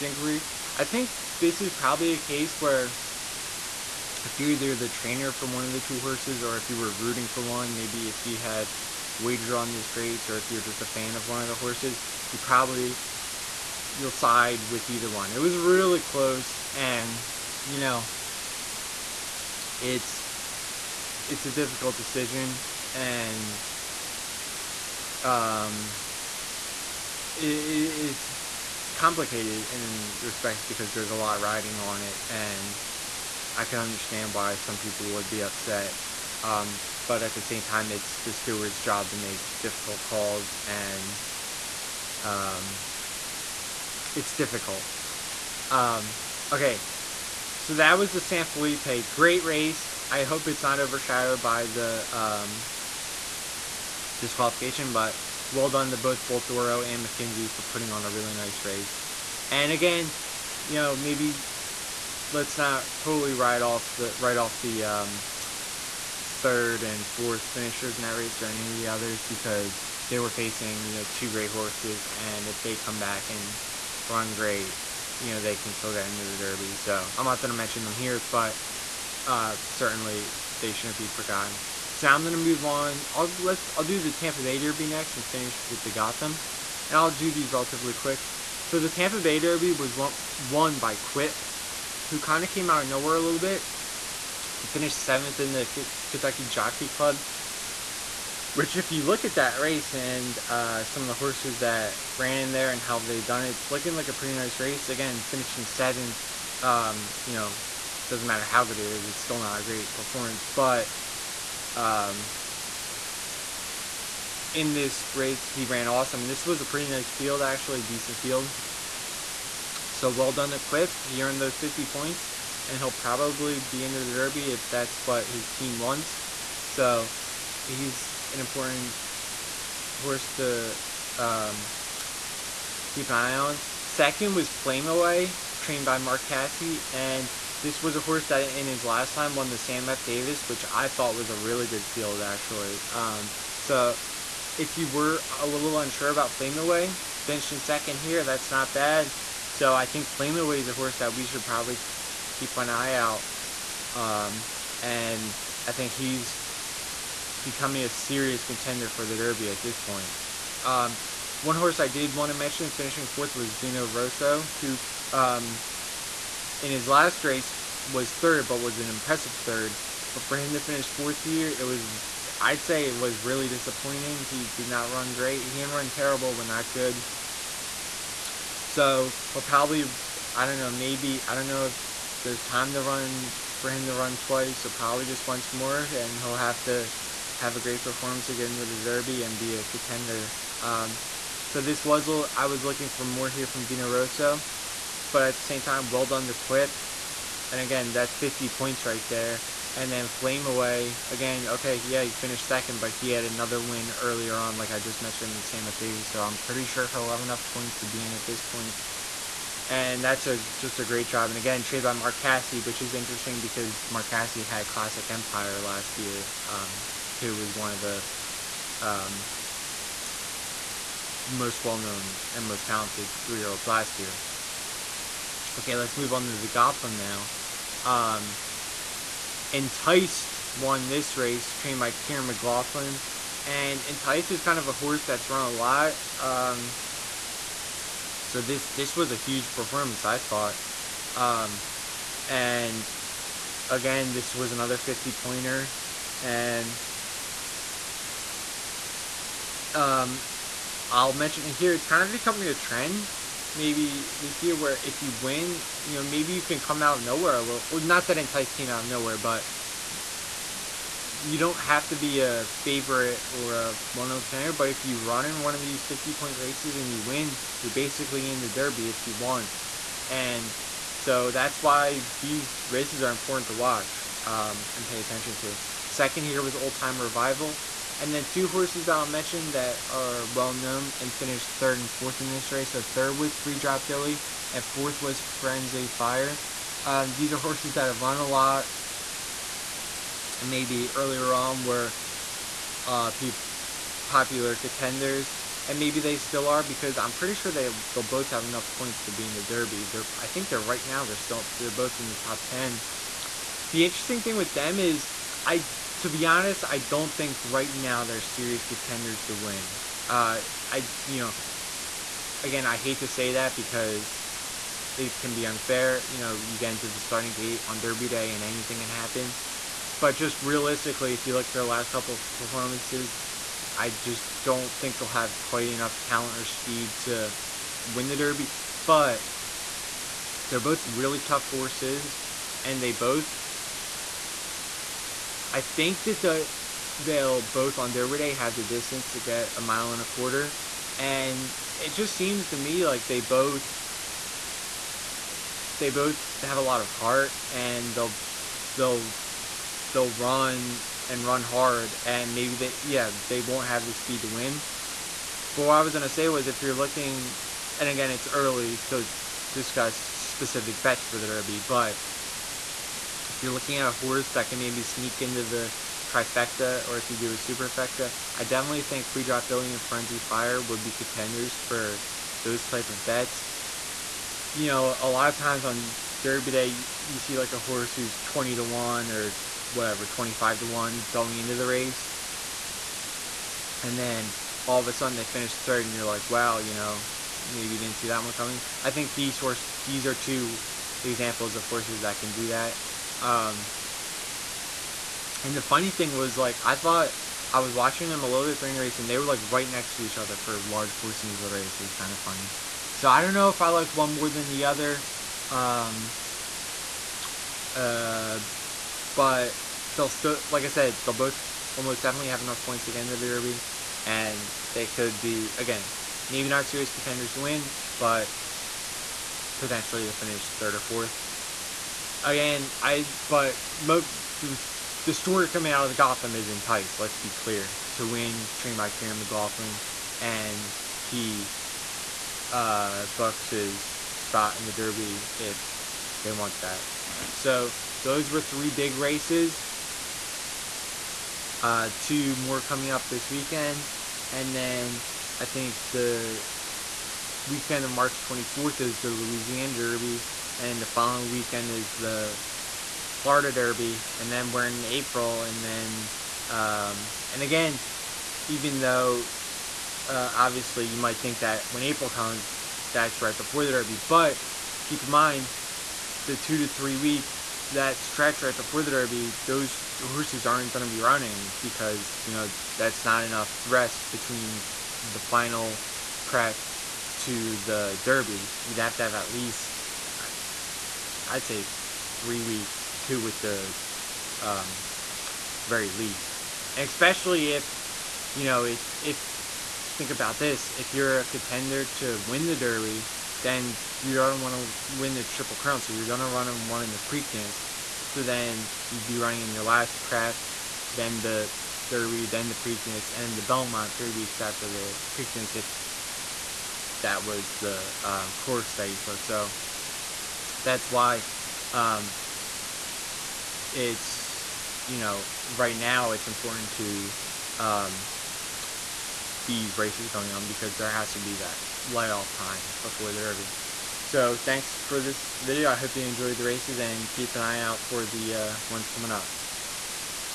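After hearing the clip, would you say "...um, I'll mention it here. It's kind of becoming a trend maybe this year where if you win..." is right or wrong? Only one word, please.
right.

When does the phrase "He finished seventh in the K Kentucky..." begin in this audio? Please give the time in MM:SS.
01:34.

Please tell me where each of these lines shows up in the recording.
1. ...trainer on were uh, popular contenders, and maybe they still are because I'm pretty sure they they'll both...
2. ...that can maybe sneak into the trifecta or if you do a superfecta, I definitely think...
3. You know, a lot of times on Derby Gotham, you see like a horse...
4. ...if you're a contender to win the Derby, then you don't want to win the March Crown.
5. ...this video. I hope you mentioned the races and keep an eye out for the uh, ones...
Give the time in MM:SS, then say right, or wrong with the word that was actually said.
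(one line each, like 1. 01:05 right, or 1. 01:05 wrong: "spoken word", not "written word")
1. 04:50 wrong: "earlier", not "trainer"
2. 06:04 right
3. 06:14 wrong: "Day", not "Gotham"
4. 08:10 wrong: "Triple", not "March"
5. 08:44 wrong: "enjoyed", not "mentioned".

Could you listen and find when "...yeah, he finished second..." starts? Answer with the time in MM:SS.
03:21.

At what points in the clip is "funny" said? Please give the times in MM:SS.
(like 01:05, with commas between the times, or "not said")
06:35, 06:42.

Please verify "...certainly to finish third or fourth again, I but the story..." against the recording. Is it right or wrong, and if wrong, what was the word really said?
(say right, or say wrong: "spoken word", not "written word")
wrong: "potentially", not "certainly".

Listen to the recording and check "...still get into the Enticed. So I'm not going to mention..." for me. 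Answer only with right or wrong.
wrong.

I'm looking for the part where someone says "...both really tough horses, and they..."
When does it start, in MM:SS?
05:30.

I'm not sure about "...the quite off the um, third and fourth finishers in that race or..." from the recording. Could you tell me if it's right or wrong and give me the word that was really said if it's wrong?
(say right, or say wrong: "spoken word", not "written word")
wrong: "write", not "quite".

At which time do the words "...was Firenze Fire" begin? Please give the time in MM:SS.
04:45.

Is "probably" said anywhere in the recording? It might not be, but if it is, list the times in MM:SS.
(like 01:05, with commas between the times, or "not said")
00:01, 00:12, 02:02, 02:31, 02:59, 03:04.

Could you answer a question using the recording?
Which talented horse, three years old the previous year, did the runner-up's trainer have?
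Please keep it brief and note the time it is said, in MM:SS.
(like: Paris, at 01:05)
Classic Empire, at 03:34.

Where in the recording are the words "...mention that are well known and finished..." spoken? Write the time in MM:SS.
04:39.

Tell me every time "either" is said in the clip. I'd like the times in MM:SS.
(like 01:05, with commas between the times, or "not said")
00:04, 00:14.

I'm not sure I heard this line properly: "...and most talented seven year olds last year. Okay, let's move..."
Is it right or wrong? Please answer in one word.
wrong.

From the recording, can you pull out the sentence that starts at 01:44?
Again, finishing seventh, um, you know, doesn't matter how good it is, it's still not a great performance.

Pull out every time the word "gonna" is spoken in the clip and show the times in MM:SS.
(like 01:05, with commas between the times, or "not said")
01:22, 05:55.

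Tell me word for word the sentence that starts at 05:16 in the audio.
You know, you get into the starting gate on Derby Day and anything can happen.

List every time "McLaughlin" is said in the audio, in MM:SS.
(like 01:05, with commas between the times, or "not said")
03:52, 07:09.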